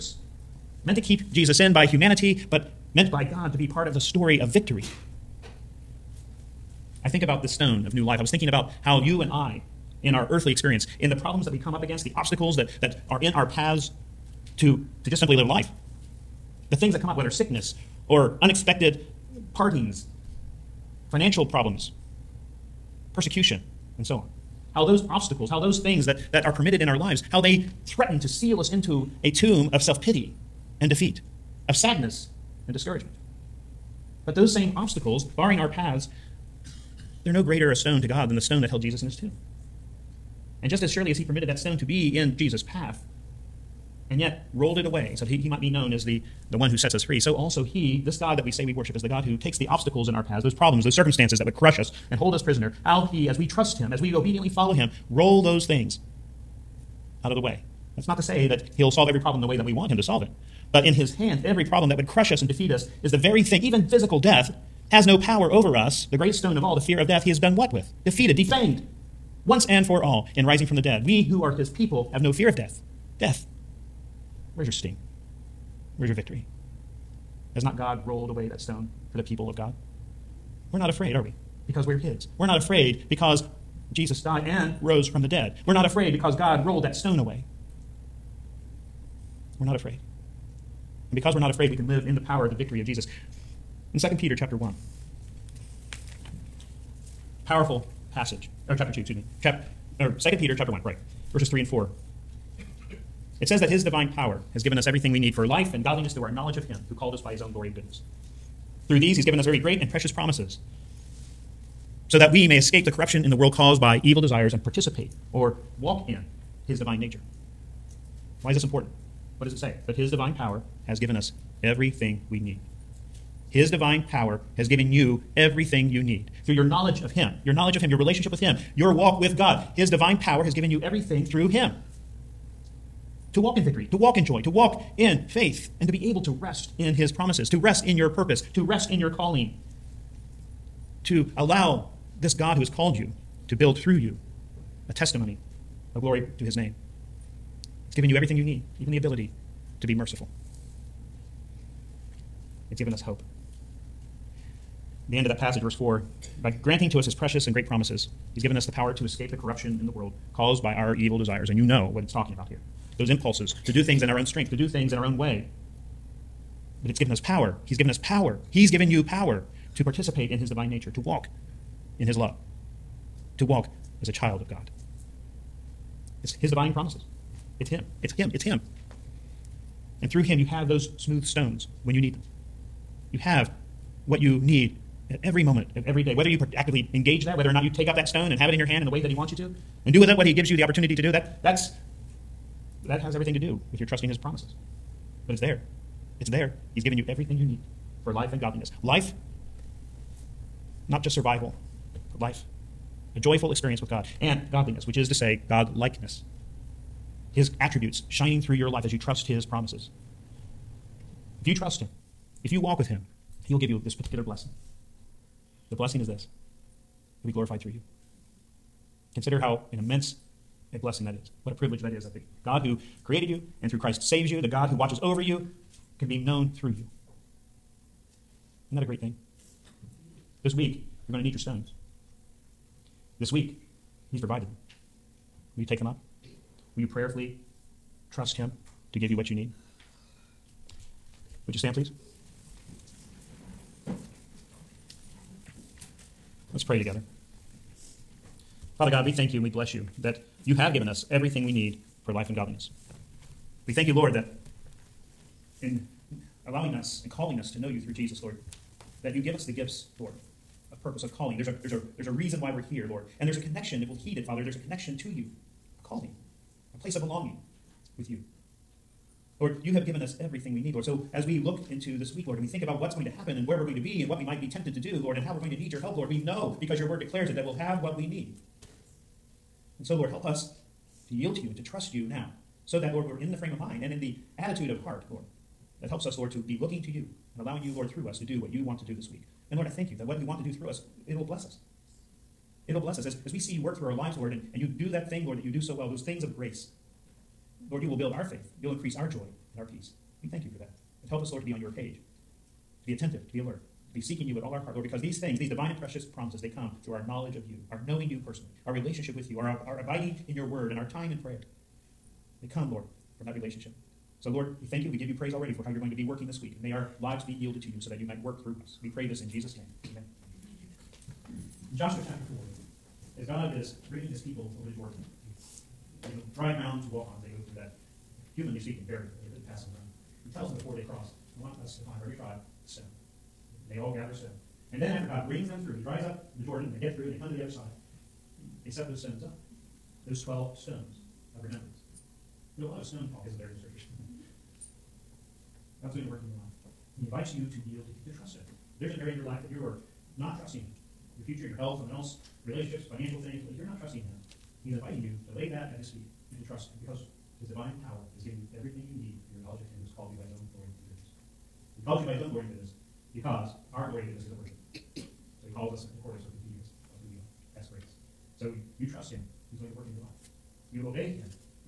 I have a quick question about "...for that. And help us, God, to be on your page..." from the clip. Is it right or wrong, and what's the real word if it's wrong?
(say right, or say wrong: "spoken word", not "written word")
wrong: "Lord", not "God".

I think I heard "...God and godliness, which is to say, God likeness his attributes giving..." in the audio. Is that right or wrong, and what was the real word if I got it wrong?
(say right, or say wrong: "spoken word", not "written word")
wrong: "shining", not "giving".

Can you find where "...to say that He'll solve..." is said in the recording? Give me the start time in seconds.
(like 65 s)
58 s.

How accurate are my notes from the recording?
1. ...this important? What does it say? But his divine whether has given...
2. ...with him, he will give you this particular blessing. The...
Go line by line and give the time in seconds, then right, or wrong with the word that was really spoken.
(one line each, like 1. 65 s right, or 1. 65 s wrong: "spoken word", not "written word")
1. 118 s wrong: "power", not "whether"
2. 212 s right.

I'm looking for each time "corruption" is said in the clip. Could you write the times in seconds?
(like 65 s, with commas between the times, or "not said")
112 s, 159 s.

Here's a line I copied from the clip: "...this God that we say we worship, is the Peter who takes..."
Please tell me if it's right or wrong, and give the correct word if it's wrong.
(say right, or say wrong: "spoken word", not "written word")
wrong: "God", not "Peter".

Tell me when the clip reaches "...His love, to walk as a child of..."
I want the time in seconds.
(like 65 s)
172 s.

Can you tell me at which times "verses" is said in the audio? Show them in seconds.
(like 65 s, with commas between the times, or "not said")
101 s, 155 s.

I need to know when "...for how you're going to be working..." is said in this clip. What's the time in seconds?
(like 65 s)
315 s.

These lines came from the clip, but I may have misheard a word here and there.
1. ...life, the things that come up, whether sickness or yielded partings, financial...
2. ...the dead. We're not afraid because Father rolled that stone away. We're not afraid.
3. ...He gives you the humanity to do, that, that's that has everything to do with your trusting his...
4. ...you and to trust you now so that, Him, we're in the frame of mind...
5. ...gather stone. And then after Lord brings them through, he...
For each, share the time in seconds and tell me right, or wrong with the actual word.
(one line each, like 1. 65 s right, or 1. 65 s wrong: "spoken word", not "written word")
1. 15 s wrong: "unexpected", not "yielded"
2. 85 s wrong: "God", not "Father"
3. 190 s wrong: "opportunity", not "humanity"
4. 281 s wrong: "Lord", not "Him"
5. 333 s wrong: "God", not "Lord".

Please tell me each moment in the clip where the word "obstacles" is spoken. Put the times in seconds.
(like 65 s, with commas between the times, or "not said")
12 s, 25 s, 34 s, 49 s.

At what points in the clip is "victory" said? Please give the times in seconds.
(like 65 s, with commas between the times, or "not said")
4 s, 76 s, 92 s, 133 s.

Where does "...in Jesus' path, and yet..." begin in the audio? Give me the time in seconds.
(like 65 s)
42 s.